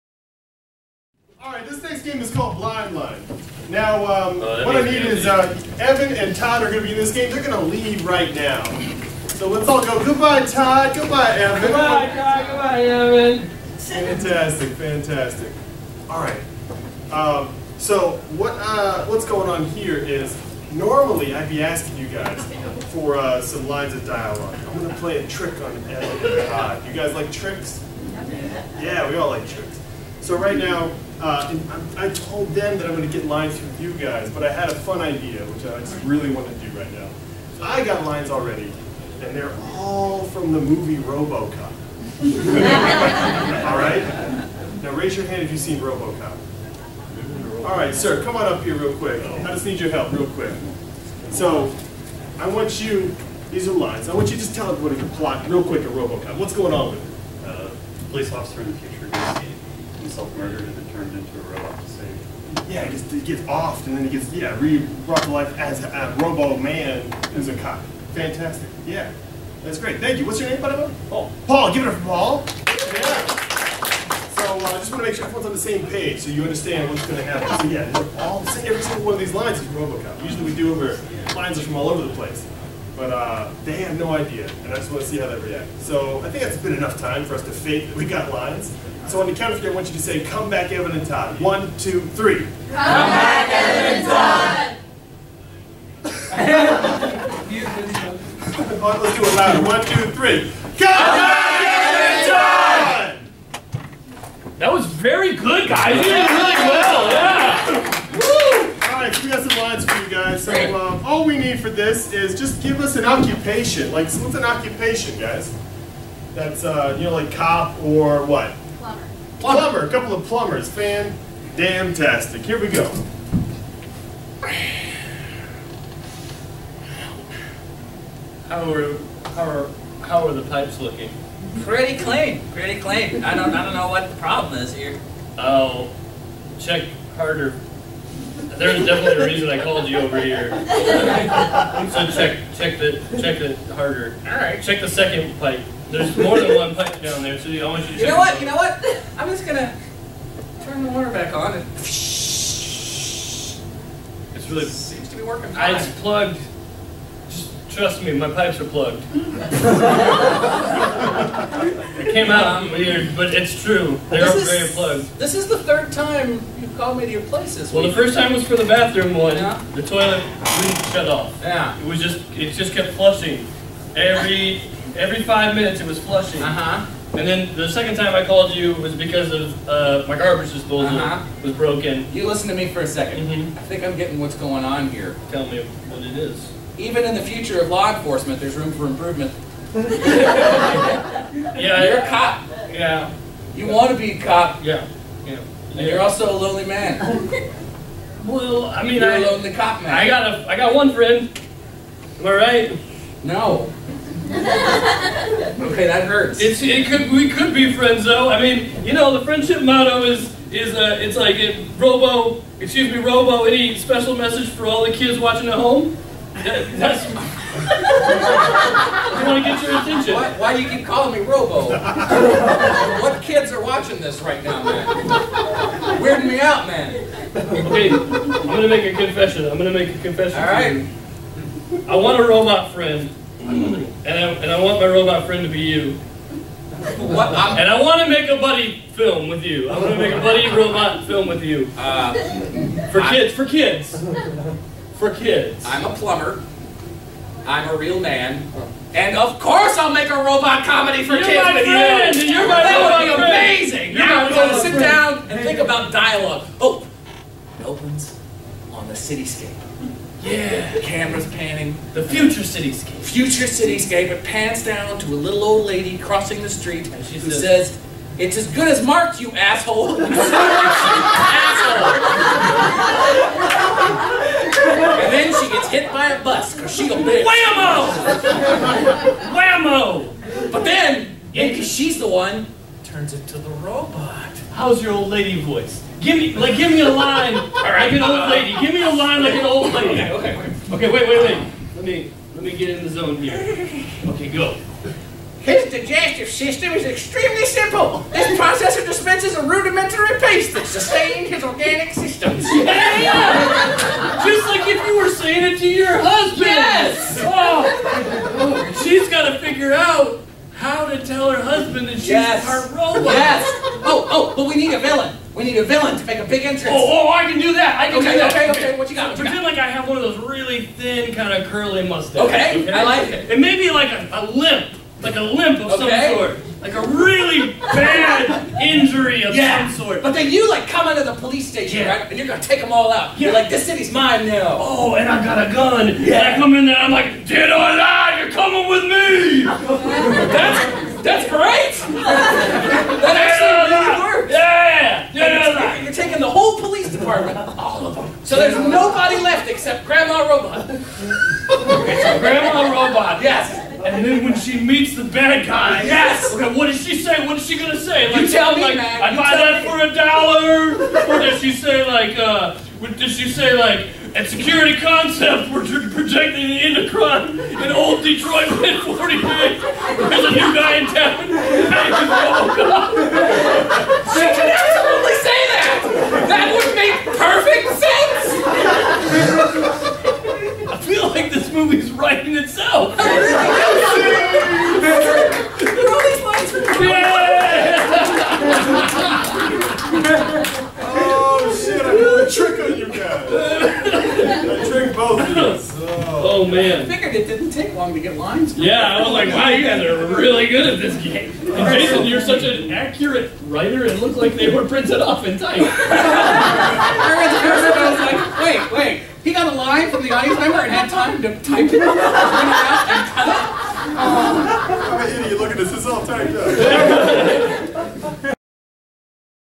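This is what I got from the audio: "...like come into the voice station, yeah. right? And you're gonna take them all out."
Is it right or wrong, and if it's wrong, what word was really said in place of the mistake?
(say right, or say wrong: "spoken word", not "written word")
wrong: "police", not "voice".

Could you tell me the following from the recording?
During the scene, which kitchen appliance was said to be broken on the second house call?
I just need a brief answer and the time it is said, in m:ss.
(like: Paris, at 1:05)
Garbage disposal, at 3:00.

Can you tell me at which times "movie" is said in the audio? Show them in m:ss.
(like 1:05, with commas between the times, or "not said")
0:40, 6:21.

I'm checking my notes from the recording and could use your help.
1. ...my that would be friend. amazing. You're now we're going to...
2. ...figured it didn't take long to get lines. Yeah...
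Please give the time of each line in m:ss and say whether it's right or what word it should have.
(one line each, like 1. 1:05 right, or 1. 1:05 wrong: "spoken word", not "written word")
1. 4:12 right
2. 6:36 right.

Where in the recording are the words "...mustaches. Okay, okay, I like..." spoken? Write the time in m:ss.
5:21.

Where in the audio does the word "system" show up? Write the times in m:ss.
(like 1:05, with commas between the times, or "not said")
4:56, 5:01.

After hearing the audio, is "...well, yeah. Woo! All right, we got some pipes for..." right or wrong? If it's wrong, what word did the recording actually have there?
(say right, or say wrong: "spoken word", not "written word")
wrong: "lines", not "pipes".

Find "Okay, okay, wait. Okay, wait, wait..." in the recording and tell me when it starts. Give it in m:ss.
4:50.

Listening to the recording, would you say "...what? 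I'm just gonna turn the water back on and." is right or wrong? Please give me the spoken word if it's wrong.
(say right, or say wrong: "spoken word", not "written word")
right.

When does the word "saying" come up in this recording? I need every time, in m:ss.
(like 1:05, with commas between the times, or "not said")
5:05.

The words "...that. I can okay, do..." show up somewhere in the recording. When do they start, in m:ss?
5:17.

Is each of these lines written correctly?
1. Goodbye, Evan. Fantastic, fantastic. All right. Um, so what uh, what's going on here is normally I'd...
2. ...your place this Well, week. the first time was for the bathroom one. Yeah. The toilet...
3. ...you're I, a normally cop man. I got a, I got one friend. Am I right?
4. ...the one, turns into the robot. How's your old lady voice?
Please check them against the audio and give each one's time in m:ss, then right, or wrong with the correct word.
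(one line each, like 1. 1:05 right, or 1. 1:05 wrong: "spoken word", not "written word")
1. 0:12 right
2. 2:47 right
3. 3:18 wrong: "lonely", not "normally"
4. 4:41 right.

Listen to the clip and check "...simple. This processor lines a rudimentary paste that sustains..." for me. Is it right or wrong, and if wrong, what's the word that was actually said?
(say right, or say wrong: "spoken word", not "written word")
wrong: "dispenses", not "lines".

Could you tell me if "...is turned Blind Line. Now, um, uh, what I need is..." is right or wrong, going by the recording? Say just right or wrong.
wrong.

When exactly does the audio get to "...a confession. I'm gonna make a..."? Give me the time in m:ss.
3:48.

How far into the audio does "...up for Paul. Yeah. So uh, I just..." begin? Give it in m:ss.
1:11.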